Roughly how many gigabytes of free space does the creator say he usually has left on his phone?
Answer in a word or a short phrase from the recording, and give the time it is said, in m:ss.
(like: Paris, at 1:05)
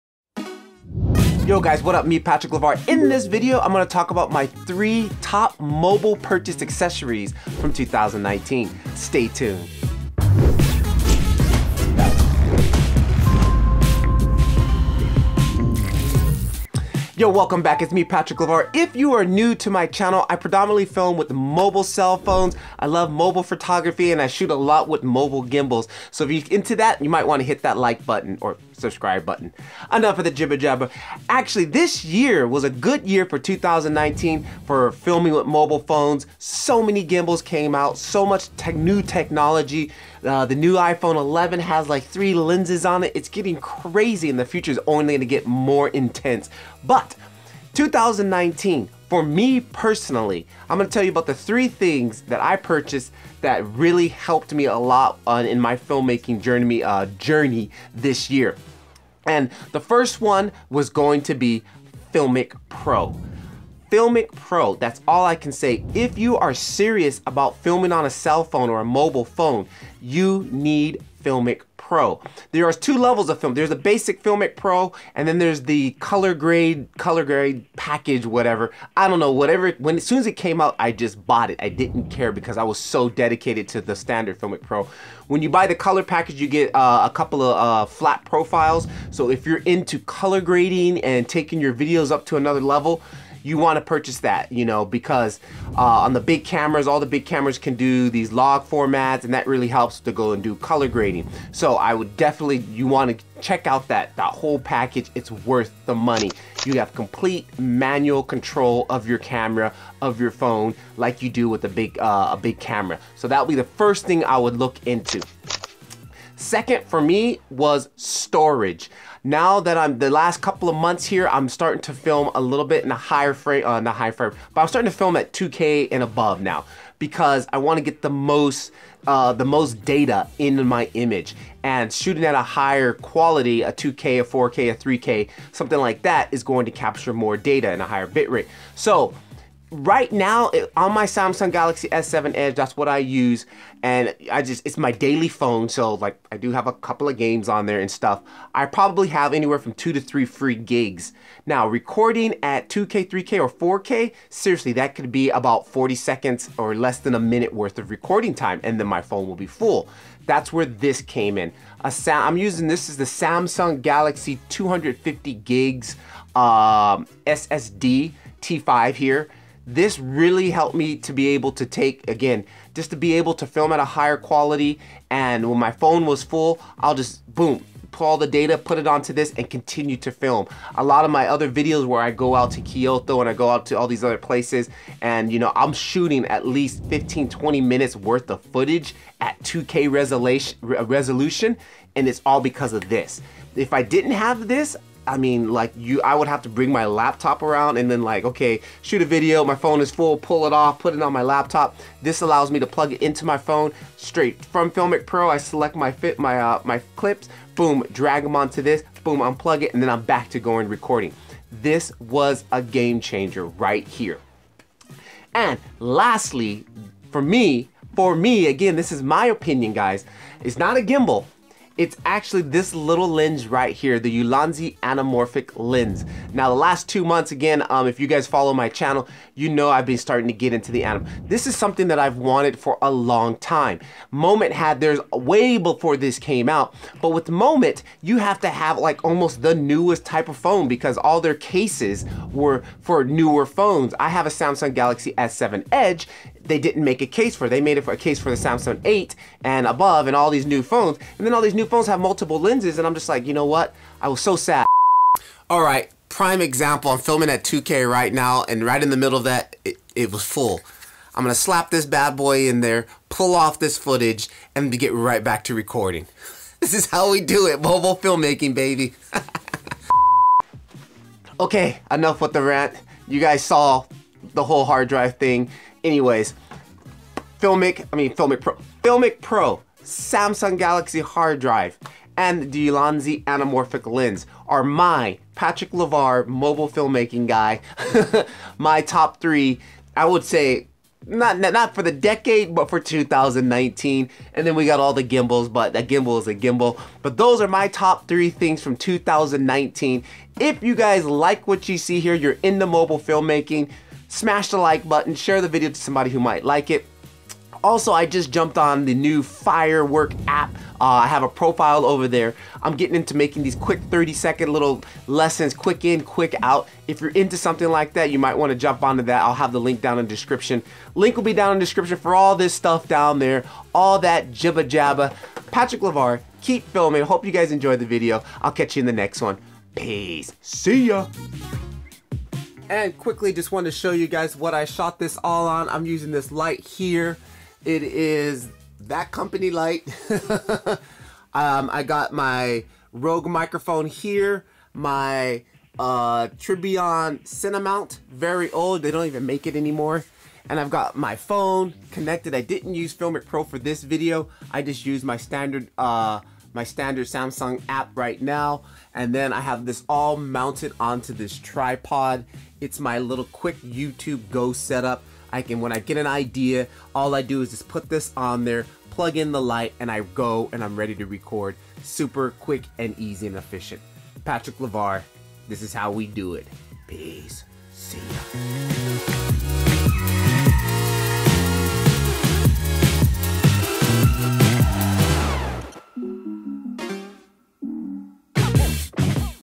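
2 to 3, at 2:29.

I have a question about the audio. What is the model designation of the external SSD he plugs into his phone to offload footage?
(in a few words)
T5.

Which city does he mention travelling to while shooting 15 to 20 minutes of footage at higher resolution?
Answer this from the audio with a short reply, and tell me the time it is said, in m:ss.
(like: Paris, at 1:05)
Kyoto, at 3:02.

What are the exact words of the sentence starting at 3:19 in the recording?
My phone is full, pull it off, put it on my laptop.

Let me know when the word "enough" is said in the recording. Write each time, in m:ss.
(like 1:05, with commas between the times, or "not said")
0:29, 4:31.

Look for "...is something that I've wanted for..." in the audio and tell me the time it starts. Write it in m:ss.
3:51.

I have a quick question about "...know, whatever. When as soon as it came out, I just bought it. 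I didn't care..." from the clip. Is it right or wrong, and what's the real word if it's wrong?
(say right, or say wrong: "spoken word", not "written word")
right.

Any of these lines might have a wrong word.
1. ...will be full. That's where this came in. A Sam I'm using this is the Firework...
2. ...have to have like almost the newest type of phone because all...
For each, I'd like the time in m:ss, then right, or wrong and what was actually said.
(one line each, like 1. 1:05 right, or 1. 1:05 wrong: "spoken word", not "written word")
1. 2:39 wrong: "Samsung", not "Firework"
2. 3:58 right.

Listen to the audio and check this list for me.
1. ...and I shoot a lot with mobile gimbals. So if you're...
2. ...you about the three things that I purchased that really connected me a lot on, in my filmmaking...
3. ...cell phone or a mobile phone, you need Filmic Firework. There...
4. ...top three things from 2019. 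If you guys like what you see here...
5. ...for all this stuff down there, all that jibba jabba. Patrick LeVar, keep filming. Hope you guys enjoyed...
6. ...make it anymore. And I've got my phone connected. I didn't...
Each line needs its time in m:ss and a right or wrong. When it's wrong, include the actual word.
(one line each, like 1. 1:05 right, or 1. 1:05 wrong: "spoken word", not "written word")
1. 0:24 right
2. 0:51 wrong: "helped", not "connected"
3. 1:08 wrong: "Pro", not "Firework"
4. 4:57 right
5. 5:21 right
6. 5:49 right.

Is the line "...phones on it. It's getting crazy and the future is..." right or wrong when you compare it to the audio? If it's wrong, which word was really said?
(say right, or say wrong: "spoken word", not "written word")
wrong: "lenses", not "phones".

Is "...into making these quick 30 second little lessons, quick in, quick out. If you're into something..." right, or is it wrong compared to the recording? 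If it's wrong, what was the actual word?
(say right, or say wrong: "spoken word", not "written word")
right.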